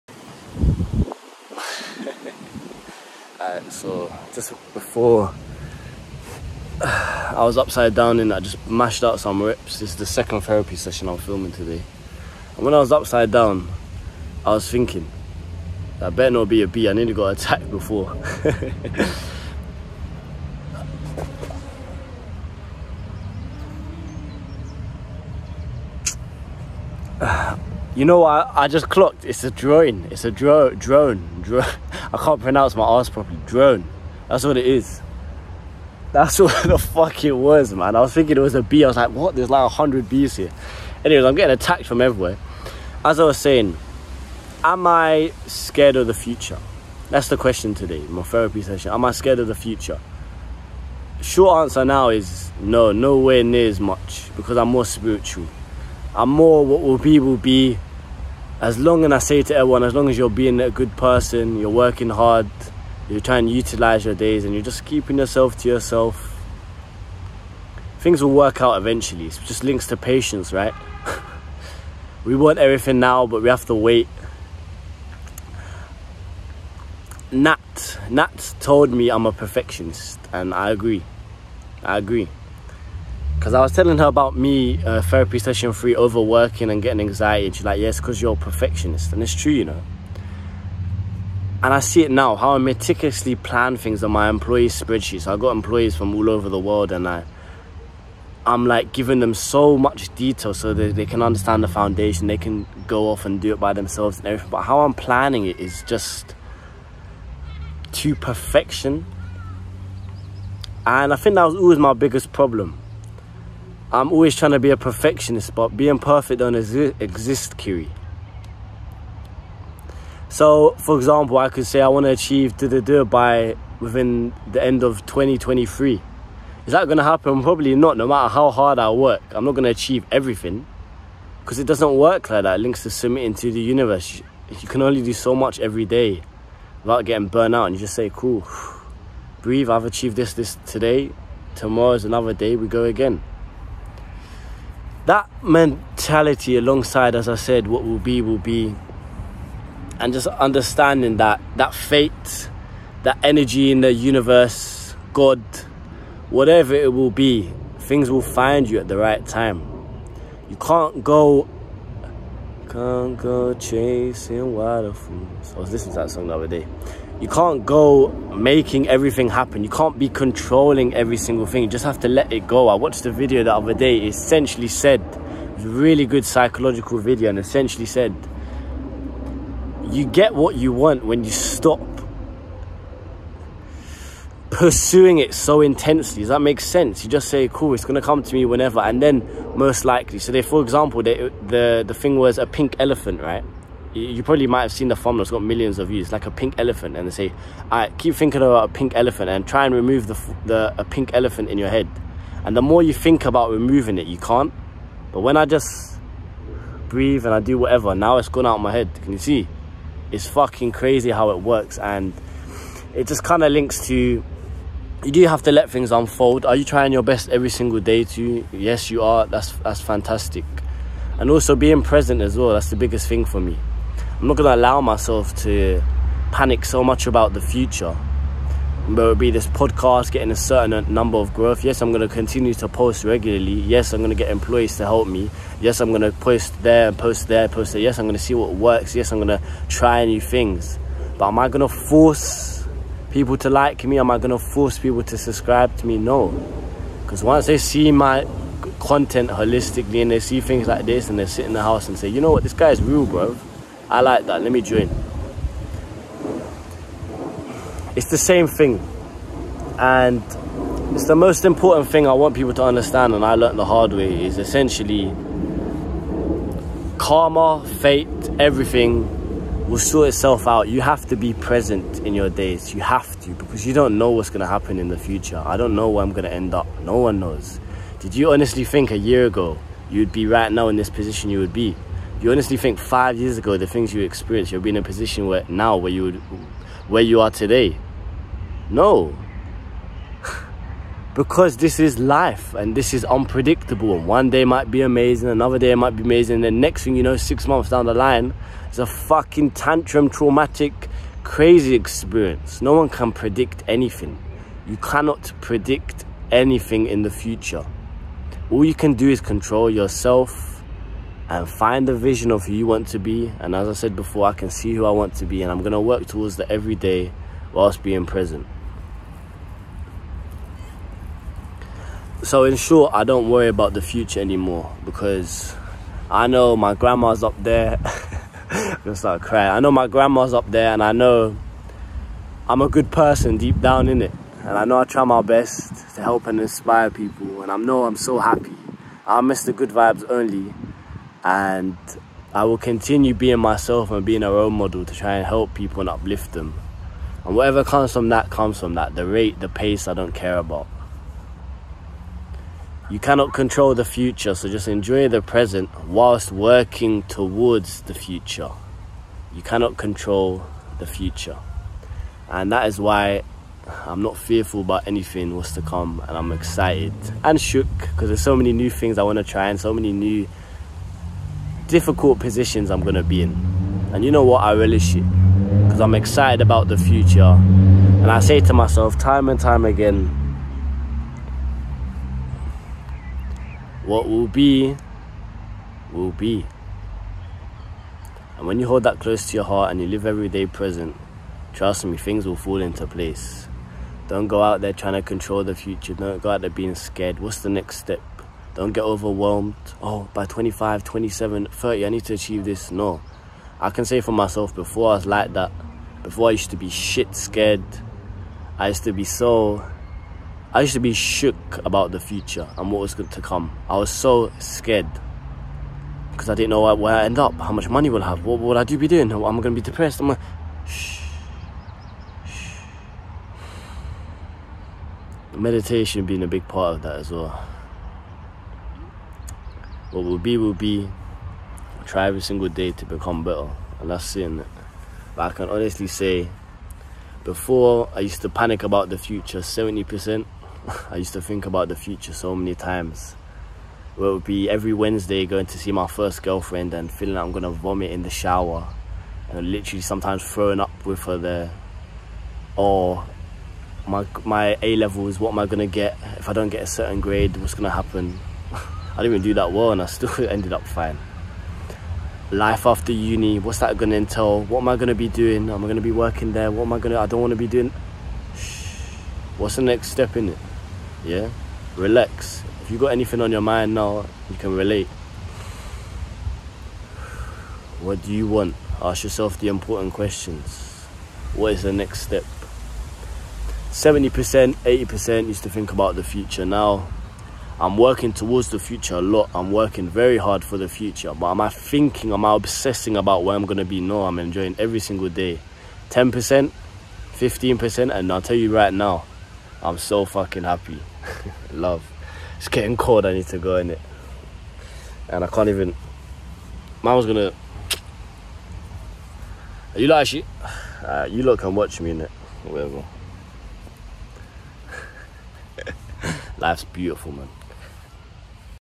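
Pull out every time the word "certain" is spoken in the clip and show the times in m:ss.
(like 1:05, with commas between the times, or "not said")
3:50, 7:36.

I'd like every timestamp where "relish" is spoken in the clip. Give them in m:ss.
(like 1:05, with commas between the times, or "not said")
6:14.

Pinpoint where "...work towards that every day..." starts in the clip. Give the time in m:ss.
5:15.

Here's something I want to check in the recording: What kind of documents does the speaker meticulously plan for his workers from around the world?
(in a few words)
employee spreadsheets.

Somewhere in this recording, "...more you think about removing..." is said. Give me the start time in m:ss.
3:22.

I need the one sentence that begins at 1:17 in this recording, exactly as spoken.
Nat, Nat told me I'm a perfectionist, and I agree.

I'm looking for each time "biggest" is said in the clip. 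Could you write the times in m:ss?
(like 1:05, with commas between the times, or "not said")
1:51, 3:42.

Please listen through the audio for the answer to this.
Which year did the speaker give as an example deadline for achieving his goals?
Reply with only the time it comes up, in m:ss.
2:05.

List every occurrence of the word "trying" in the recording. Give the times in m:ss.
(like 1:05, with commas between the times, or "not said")
1:03, 1:54, 3:36, 6:34.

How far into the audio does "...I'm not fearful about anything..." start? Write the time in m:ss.
6:03.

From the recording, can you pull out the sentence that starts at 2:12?
It links to submitting to the universe.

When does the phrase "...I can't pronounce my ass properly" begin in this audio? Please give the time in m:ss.
0:32.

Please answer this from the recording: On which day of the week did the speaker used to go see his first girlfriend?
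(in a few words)
Wednesday.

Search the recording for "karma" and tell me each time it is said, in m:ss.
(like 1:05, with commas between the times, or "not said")
4:26.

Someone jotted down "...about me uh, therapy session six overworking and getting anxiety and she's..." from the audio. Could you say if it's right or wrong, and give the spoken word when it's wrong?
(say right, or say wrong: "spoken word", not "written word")
wrong: "three", not "six".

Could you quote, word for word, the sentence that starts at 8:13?
No, I'm enjoying every single day.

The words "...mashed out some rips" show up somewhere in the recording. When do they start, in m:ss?
0:08.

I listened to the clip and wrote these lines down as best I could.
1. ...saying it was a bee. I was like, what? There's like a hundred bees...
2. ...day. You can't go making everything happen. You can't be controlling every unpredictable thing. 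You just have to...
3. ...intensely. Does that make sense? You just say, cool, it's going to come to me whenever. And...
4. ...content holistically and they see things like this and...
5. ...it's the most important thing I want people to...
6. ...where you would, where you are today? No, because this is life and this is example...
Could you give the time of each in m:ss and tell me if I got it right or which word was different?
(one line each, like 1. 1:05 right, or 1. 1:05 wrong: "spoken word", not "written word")
1. 0:38 wrong: "thinking", not "saying"
2. 2:46 wrong: "single", not "unpredictable"
3. 3:05 right
4. 4:08 right
5. 4:20 right
6. 4:45 wrong: "unpredictable", not "example".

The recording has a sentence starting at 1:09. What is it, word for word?
It's just links to patience, right?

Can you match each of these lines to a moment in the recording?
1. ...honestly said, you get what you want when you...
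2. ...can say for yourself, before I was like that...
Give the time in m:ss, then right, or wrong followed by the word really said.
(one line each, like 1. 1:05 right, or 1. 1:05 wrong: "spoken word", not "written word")
1. 2:57 wrong: "essentially", not "honestly"
2. 6:43 wrong: "myself", not "yourself".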